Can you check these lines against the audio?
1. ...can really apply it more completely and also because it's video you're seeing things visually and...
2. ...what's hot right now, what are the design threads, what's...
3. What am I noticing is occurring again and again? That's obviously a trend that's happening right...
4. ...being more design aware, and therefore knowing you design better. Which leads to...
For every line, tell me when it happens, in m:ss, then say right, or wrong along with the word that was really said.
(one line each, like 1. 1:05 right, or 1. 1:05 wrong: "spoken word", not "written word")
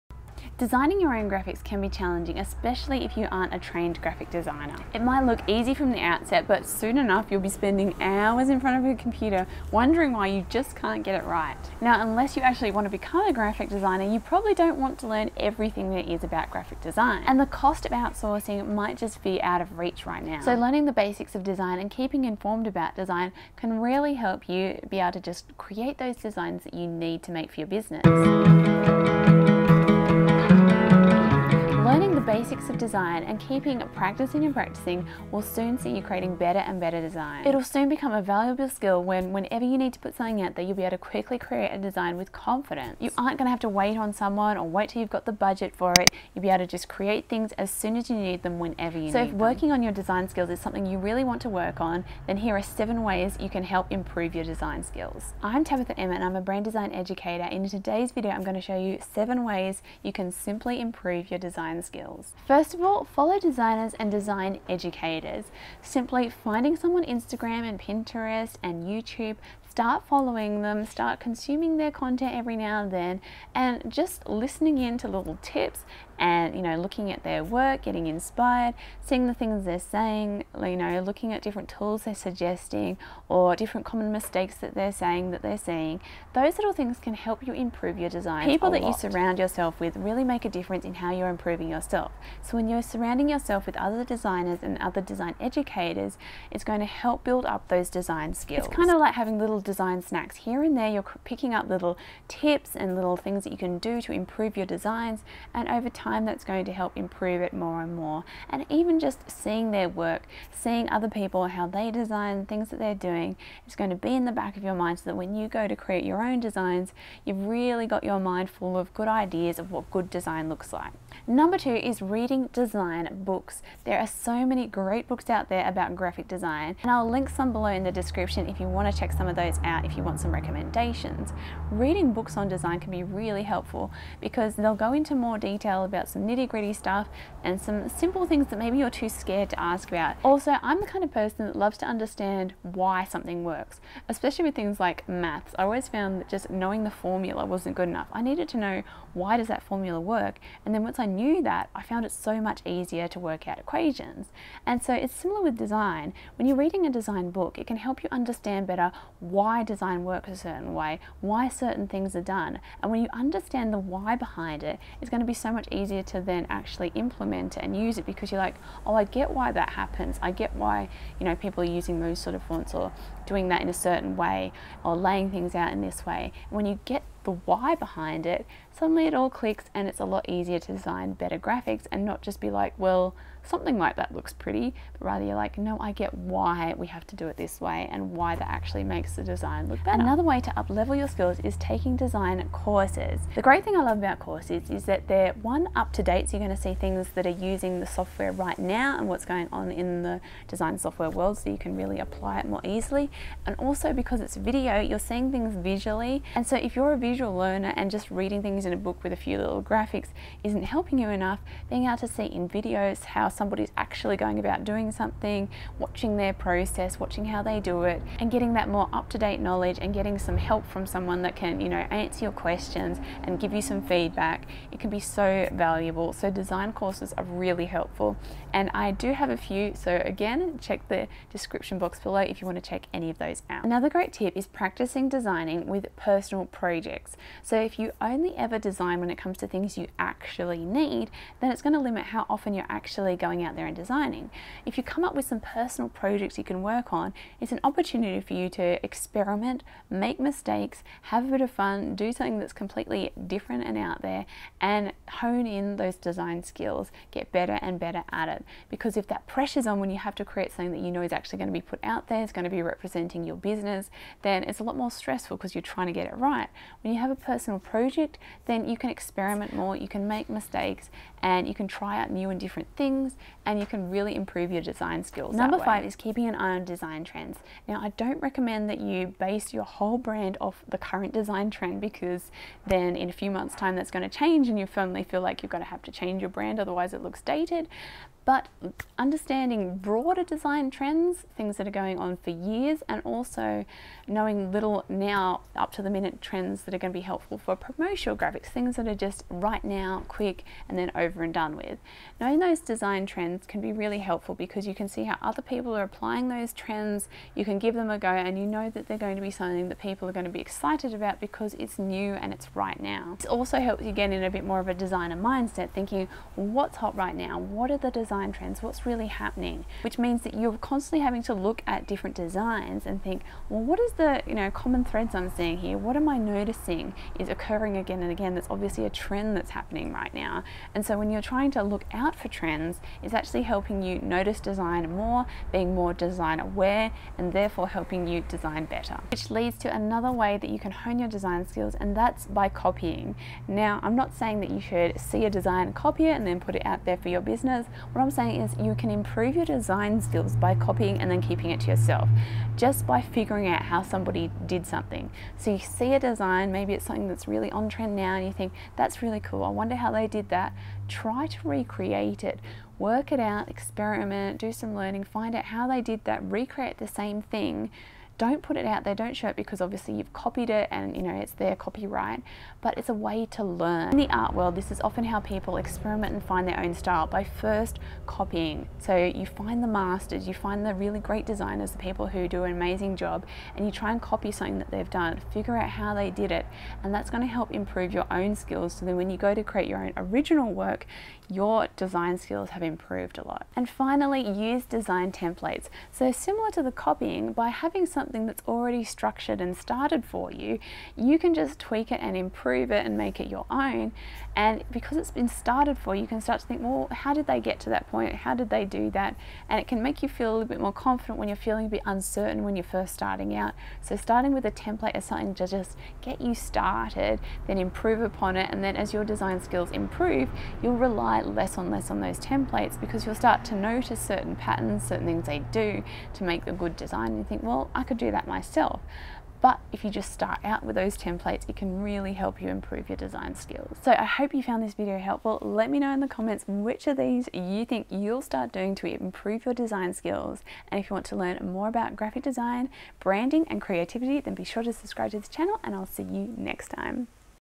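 1. 3:21 wrong: "easily", not "completely"
2. 5:16 wrong: "trends", not "threads"
3. 5:25 right
4. 5:35 wrong: "helping", not "knowing".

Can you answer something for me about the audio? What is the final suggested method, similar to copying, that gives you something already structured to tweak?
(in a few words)
Design templates.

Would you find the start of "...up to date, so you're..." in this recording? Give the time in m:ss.
3:15.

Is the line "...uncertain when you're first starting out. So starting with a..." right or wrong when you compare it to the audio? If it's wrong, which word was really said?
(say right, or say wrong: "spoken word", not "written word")
right.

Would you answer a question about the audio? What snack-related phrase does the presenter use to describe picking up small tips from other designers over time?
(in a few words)
Design snacks.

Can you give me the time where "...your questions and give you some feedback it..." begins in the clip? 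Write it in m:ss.
3:42.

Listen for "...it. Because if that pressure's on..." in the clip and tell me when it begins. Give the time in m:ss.
4:18.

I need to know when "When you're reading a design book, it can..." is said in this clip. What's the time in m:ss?
2:36.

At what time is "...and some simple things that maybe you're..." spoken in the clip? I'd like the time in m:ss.
2:17.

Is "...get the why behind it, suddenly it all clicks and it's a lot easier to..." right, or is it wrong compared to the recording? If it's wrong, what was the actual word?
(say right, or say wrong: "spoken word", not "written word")
right.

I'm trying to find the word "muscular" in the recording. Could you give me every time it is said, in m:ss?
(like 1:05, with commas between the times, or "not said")
not said.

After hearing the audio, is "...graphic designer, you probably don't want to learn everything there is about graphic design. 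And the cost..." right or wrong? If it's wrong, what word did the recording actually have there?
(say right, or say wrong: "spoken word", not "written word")
right.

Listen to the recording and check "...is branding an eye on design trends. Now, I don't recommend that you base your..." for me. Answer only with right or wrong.
wrong.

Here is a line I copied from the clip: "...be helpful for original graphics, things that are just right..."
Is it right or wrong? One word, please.
wrong.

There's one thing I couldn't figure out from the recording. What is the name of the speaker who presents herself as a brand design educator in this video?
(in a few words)
Tabitha Emma.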